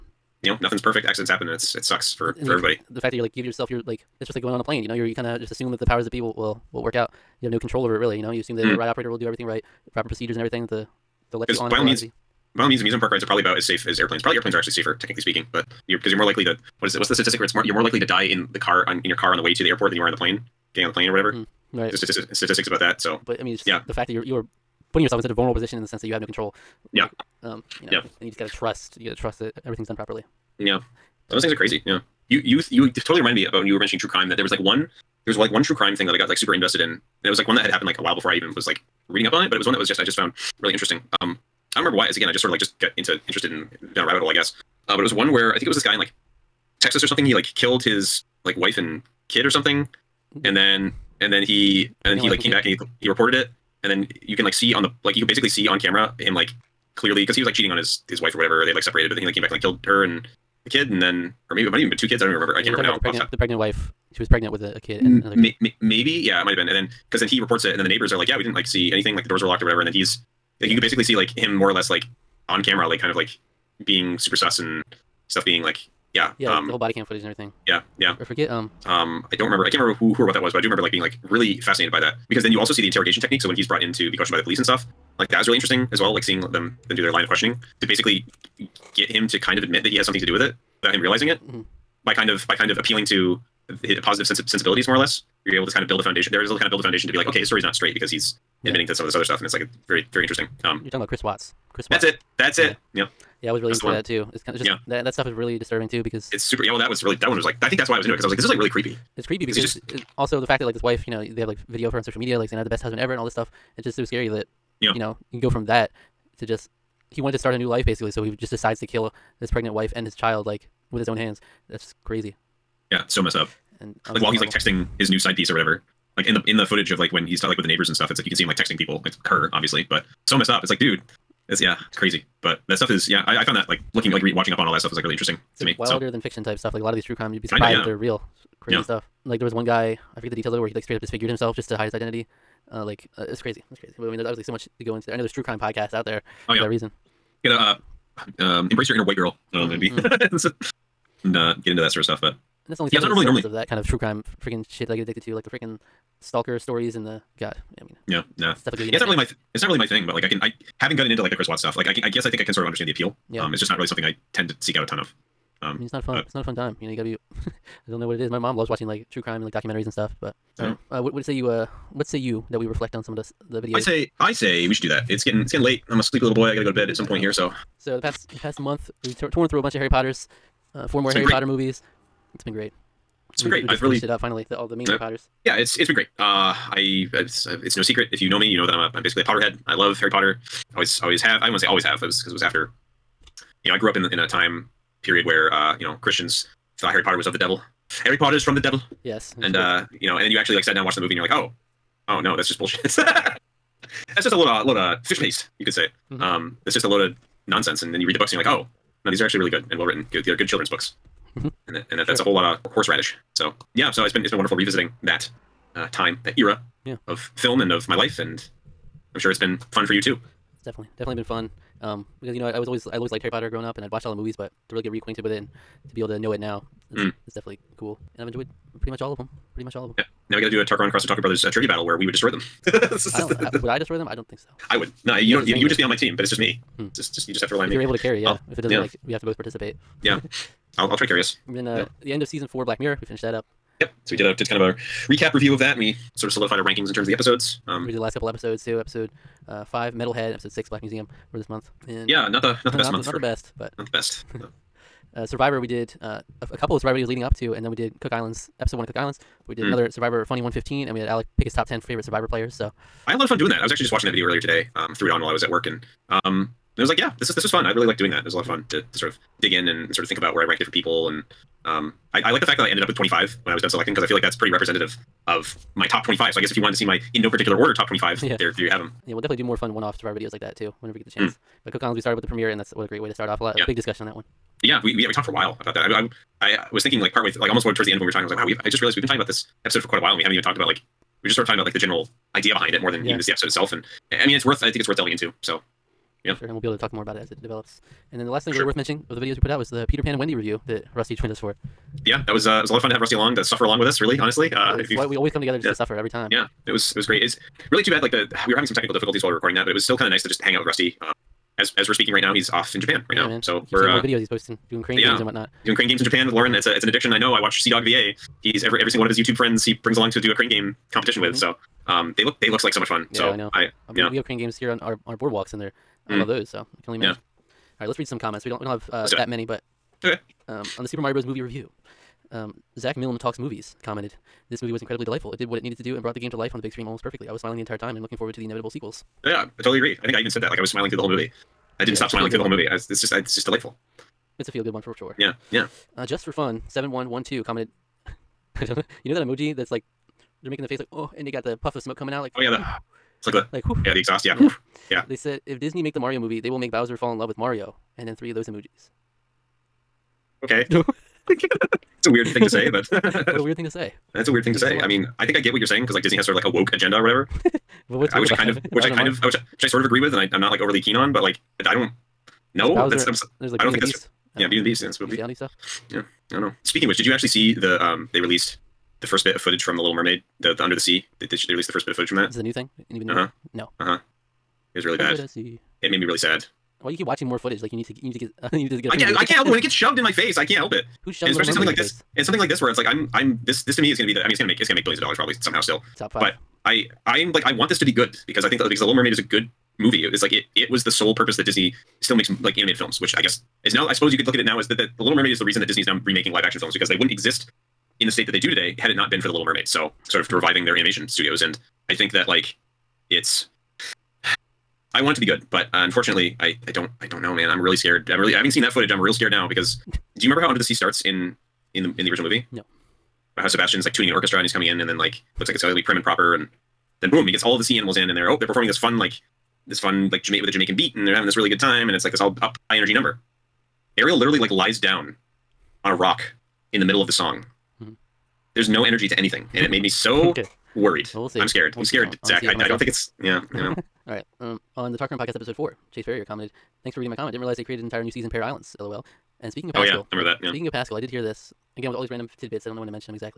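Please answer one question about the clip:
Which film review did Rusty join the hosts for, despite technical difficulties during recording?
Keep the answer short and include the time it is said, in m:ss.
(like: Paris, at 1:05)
Peter Pan and Wendy, at 4:59.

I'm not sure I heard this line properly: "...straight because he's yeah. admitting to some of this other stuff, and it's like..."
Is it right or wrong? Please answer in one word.
right.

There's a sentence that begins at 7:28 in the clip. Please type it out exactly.
LOL." And speaking of Pascal, oh yeah, I remember that.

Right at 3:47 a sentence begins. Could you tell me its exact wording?
it's definitely cool, and I've enjoyed pretty much all of them.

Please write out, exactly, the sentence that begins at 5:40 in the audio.
Like I was smiling through the whole movie.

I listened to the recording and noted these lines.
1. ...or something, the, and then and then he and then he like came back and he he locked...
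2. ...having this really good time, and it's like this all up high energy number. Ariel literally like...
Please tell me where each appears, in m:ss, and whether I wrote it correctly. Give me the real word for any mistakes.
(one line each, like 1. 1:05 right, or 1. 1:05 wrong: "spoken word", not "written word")
1. 0:49 wrong: "reported", not "locked"
2. 7:11 right.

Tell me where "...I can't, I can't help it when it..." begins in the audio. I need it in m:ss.
6:28.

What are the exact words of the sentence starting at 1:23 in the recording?
So when he's brought in to be questioned by the police and stuff, like that is really interesting as well.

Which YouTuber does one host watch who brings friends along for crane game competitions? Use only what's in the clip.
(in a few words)
CDawgVA.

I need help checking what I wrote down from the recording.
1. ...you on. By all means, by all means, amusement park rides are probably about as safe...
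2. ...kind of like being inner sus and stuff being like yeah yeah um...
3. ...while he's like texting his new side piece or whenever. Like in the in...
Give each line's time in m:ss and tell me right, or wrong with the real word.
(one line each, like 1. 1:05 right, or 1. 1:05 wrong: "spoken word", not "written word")
1. 0:11 right
2. 1:12 wrong: "super", not "inner"
3. 2:04 wrong: "whatever", not "whenever".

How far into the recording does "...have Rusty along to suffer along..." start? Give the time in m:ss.
5:02.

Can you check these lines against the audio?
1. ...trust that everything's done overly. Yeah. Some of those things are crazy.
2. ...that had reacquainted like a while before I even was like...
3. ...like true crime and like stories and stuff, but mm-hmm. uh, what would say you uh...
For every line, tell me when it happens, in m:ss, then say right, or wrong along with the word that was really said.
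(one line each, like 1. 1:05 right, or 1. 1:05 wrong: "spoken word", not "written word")
1. 0:29 wrong: "properly", not "overly"
2. 0:37 wrong: "happened", not "reacquainted"
3. 2:48 wrong: "documentaries", not "stories".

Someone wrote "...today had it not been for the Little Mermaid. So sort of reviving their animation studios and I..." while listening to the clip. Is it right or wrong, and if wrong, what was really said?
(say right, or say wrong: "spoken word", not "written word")
right.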